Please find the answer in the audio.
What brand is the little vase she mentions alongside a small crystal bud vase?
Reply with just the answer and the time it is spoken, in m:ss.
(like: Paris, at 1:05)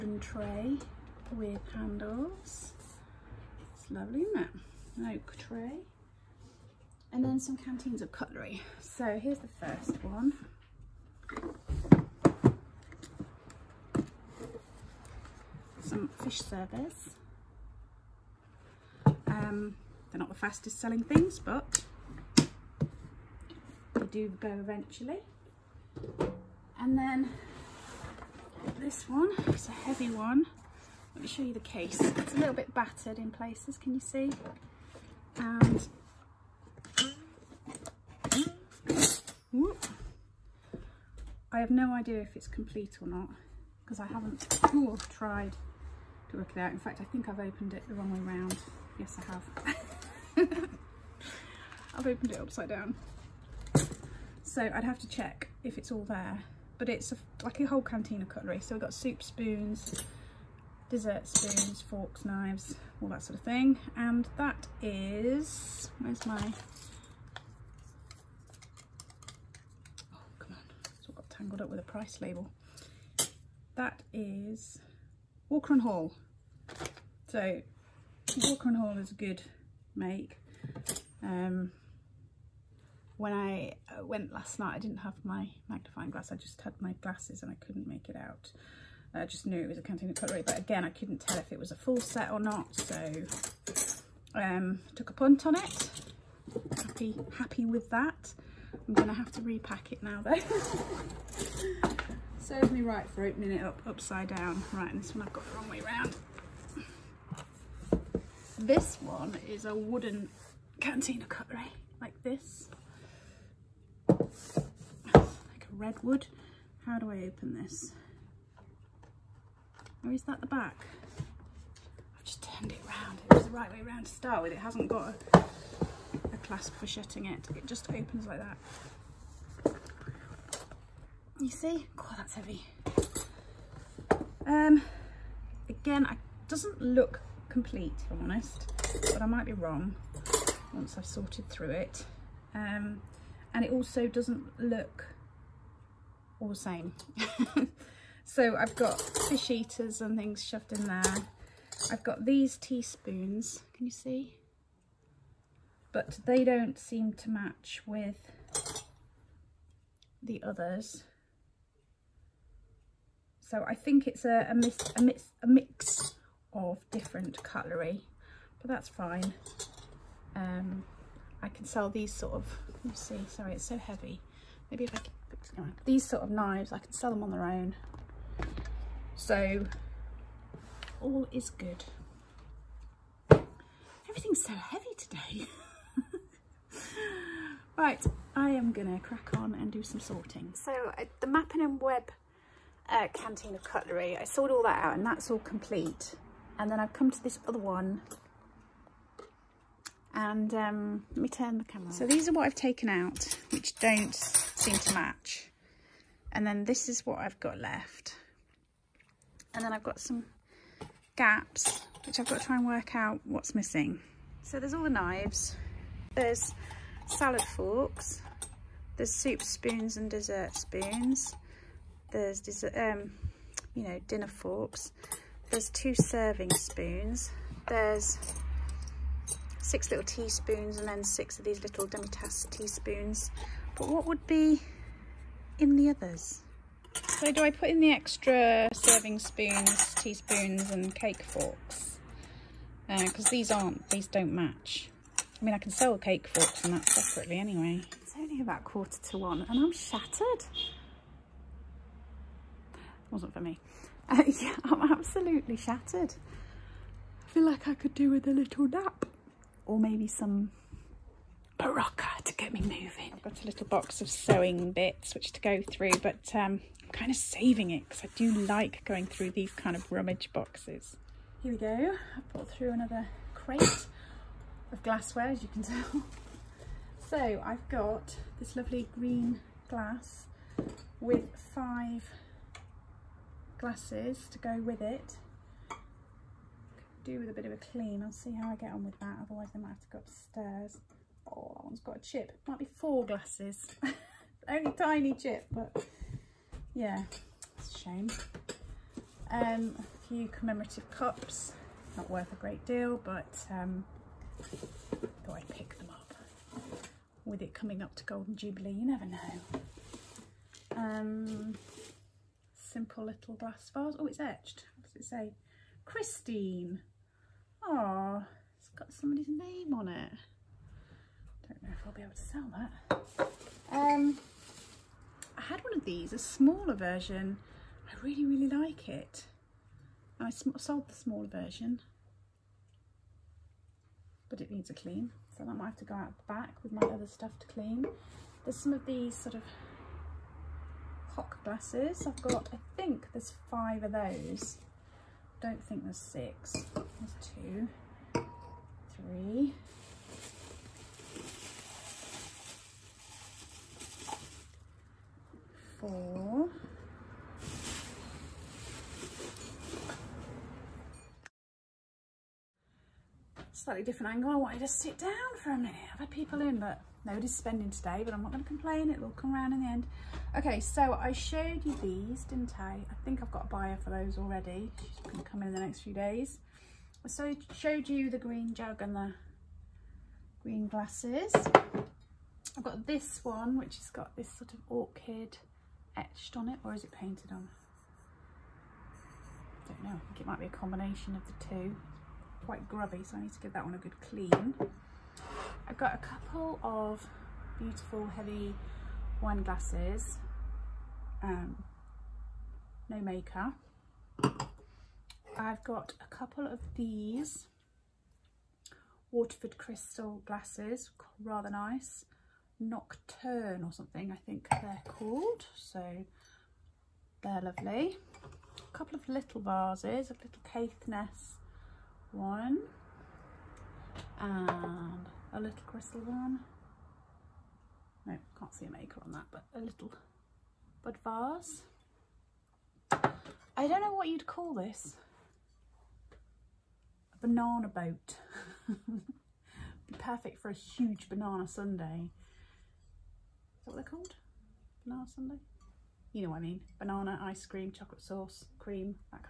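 Caithness, at 7:00.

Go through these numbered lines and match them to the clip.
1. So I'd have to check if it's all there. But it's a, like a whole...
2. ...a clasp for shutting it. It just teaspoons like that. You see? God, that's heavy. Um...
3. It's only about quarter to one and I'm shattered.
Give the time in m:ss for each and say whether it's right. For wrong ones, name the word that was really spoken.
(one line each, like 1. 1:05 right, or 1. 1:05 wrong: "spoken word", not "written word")
1. 0:54 right
2. 2:06 wrong: "opens", not "teaspoons"
3. 4:08 right.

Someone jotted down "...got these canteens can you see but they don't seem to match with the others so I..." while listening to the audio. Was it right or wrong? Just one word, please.
wrong.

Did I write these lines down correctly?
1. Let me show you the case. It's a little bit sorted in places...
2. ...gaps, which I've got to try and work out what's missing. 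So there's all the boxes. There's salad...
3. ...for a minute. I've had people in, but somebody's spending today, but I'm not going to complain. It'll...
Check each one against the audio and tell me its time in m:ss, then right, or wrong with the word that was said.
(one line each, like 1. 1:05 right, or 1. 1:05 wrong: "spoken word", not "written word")
1. 0:31 wrong: "battered", not "sorted"
2. 3:31 wrong: "knives", not "boxes"
3. 6:05 wrong: "nobody", not "somebody".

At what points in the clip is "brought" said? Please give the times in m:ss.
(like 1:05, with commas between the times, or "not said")
4:32.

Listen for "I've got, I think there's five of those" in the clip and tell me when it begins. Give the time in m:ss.
5:42.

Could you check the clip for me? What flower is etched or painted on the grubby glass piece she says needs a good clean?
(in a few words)
Orchid.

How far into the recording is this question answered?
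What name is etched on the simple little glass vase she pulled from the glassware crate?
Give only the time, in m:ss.
5:15.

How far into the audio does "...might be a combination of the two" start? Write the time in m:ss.
6:30.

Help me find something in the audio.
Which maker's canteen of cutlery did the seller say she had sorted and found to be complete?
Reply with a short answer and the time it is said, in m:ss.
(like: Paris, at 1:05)
Mappin and Webb, at 3:11.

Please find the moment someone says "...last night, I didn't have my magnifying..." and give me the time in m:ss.
1:24.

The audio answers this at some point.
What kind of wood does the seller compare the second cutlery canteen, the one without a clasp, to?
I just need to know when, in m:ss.
1:55.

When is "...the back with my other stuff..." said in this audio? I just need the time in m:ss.
5:36.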